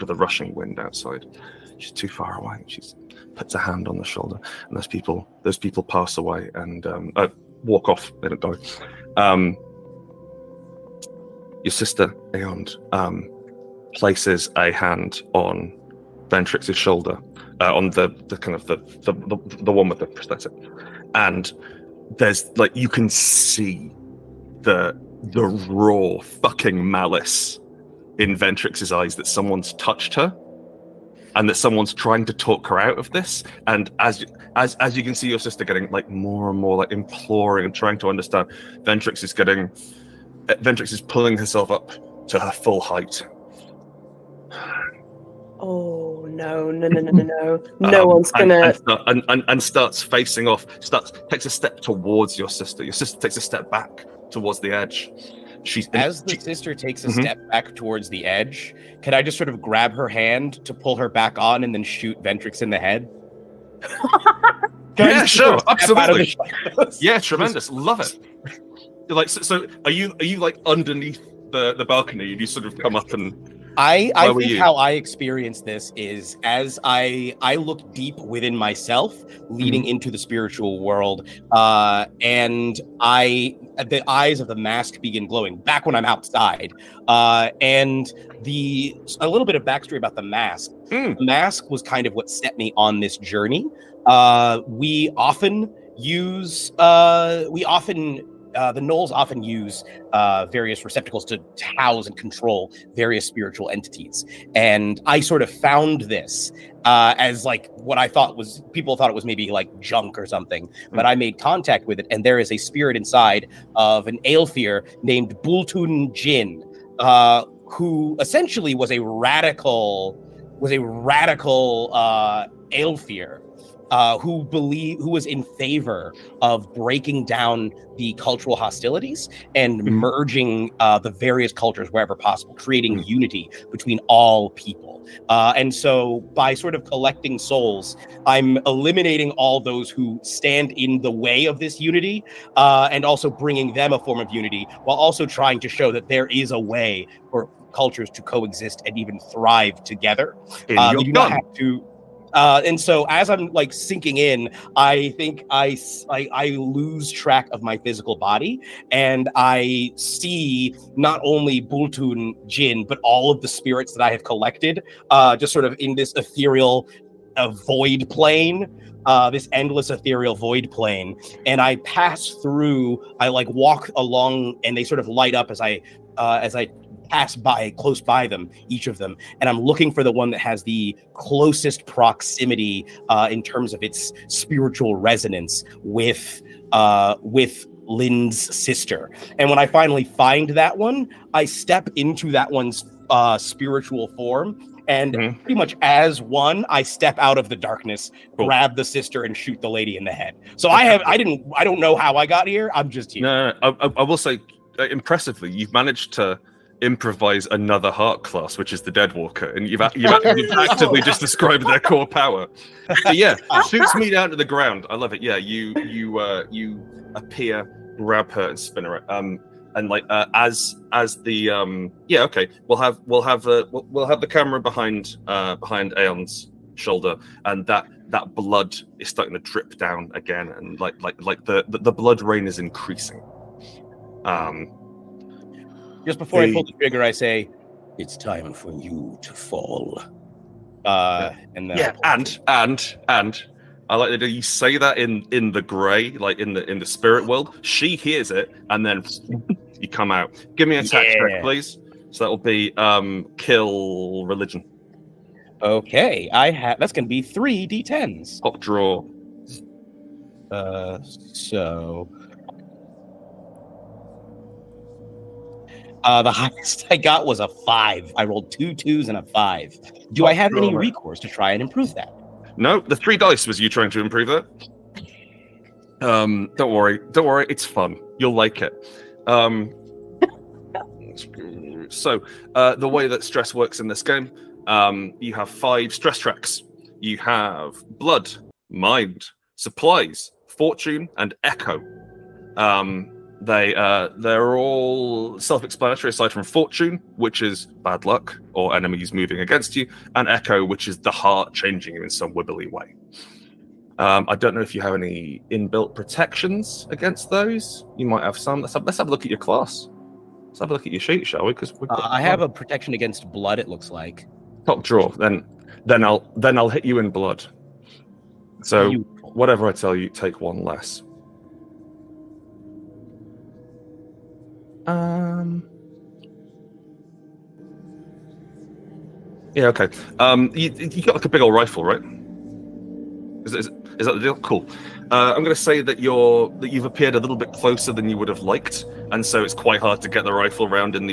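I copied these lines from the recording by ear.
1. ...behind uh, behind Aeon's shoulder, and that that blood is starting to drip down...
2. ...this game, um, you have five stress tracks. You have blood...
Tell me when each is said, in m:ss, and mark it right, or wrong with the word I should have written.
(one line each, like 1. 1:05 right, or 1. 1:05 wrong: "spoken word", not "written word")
1. 3:44 right
2. 4:43 right.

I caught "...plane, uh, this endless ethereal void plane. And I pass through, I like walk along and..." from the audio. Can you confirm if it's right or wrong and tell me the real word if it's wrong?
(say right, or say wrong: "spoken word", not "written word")
right.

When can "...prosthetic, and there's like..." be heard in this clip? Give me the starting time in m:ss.
0:20.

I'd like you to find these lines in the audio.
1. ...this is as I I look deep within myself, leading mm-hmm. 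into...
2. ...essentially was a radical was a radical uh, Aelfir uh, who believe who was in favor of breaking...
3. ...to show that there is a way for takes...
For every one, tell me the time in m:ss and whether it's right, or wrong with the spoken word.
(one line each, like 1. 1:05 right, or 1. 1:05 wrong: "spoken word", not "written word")
1. 1:15 right
2. 1:58 right
3. 2:25 wrong: "cultures", not "takes".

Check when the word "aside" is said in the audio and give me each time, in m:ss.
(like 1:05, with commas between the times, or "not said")
4:56.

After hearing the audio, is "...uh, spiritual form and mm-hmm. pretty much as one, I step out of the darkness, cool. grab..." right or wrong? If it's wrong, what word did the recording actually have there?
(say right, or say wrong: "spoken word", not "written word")
right.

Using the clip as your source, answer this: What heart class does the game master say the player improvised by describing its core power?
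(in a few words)
Deadwalker.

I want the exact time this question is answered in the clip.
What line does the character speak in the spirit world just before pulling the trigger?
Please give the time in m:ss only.
3:57.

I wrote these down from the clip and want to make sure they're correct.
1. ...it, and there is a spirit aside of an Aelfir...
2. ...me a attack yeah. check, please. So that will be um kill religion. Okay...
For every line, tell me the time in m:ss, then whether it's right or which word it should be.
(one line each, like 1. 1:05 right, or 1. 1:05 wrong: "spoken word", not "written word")
1. 1:52 wrong: "inside", not "aside"
2. 4:10 right.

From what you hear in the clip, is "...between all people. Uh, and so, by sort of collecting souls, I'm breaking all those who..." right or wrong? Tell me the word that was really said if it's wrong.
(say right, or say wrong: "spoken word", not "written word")
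wrong: "eliminating", not "breaking".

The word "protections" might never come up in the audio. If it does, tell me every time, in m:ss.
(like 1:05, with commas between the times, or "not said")
5:05, 5:12.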